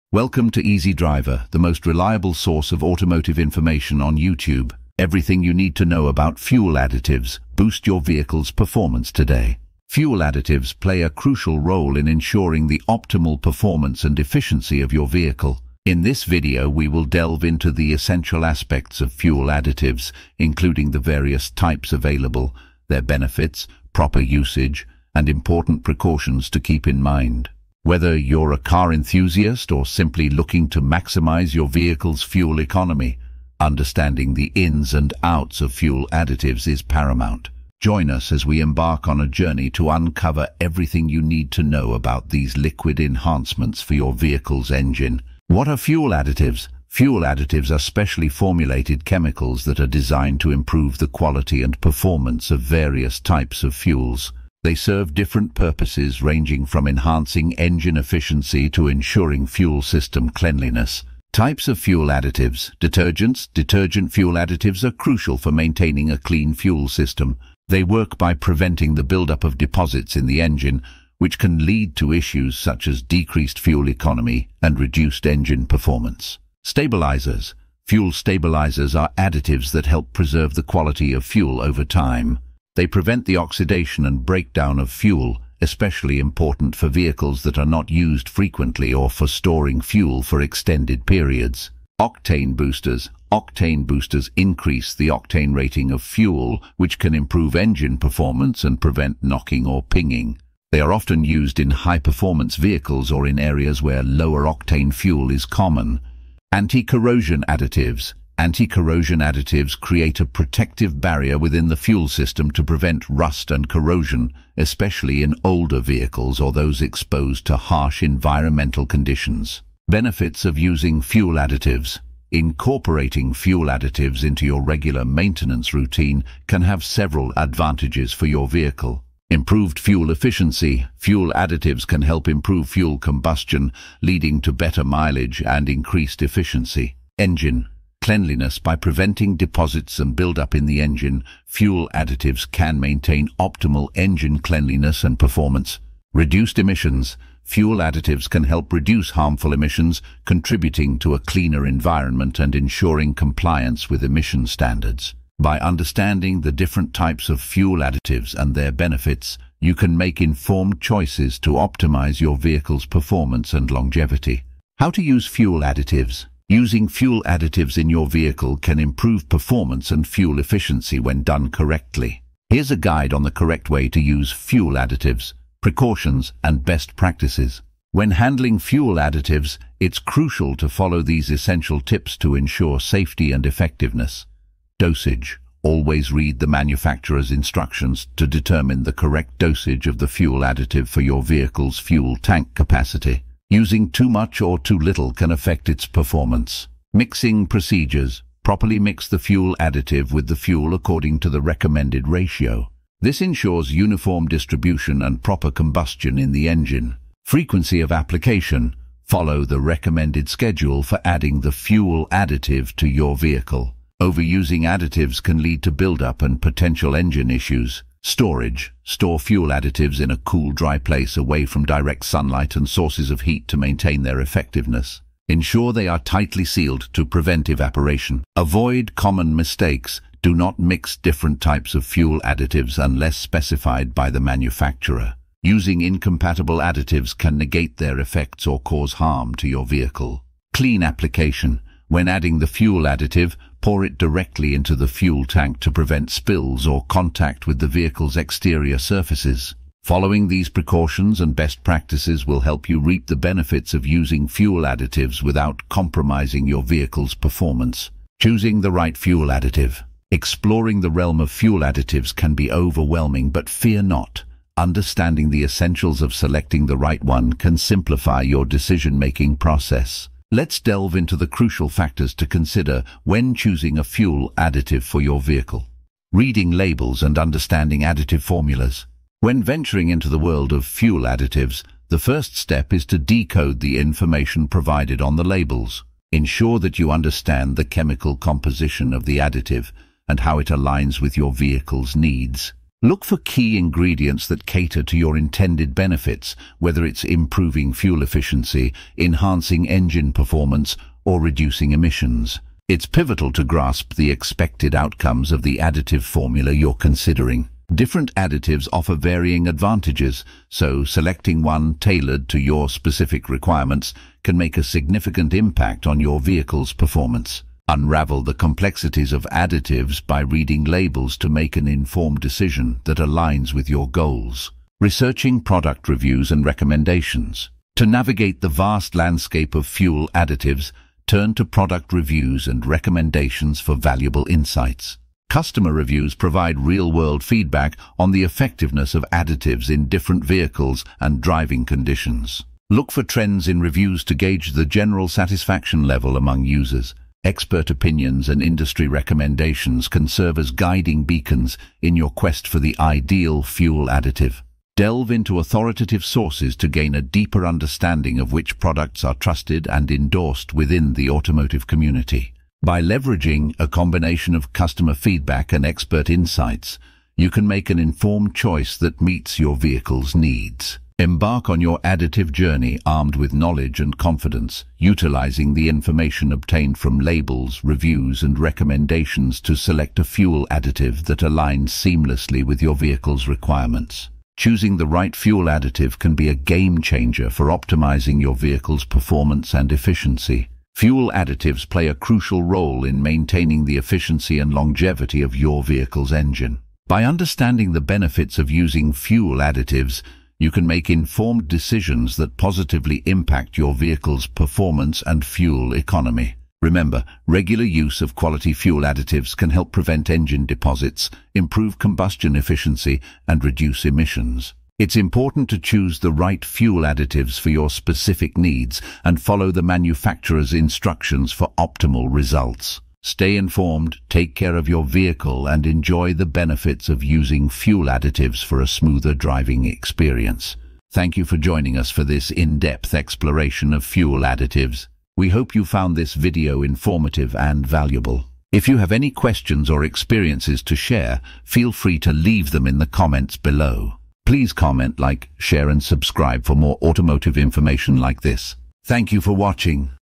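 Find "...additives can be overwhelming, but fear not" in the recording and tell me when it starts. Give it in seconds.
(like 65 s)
261 s.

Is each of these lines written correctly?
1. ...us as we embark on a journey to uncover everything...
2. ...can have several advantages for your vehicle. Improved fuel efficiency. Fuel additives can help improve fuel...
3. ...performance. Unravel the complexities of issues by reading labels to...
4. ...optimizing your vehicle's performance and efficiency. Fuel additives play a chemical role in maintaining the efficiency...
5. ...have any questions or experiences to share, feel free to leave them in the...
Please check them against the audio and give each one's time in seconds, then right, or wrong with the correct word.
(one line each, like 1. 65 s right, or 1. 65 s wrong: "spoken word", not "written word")
1. 38 s right
2. 126 s right
3. 316 s wrong: "additives", not "issues"
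4. 387 s wrong: "crucial", not "chemical"
5. 438 s right.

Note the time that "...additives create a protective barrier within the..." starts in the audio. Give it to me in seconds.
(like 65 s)
109 s.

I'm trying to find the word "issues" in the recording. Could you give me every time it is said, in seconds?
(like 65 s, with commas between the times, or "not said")
72 s, 217 s.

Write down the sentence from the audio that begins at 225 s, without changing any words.
Ensure they are tightly sealed to prevent evaporation.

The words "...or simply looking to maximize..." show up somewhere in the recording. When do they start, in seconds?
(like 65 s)
29 s.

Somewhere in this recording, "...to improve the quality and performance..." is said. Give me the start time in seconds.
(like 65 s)
50 s.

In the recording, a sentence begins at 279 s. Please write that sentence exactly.
When venturing into the world of fuel additives, the first step is to decode the information provided on the labels.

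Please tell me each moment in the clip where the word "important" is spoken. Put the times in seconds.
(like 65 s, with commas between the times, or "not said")
25 s, 86 s, 414 s.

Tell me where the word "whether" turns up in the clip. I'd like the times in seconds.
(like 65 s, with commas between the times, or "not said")
27 s, 296 s.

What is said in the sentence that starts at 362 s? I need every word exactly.
By leveraging a combination of customer feedback and expert insights, you can make an informed choice that meets your vehicle's needs.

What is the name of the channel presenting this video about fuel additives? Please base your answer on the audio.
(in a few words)
Easy Driver.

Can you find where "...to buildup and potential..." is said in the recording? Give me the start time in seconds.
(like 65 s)
215 s.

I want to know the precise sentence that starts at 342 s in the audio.
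Look for trends in reviews to gauge the general satisfaction level among users.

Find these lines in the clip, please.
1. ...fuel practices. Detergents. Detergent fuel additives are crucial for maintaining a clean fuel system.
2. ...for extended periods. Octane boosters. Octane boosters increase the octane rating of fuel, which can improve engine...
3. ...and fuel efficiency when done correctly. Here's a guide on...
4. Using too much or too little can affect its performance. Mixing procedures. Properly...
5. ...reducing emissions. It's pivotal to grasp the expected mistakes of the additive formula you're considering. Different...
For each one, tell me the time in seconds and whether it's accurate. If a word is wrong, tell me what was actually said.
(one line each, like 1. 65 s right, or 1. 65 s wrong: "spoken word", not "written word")
1. 61 s wrong: "additives", not "practices"
2. 90 s right
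3. 169 s right
4. 193 s right
5. 301 s wrong: "outcomes", not "mistakes".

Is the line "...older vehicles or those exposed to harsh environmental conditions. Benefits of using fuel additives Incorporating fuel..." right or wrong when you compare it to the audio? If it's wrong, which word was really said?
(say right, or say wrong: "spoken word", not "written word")
right.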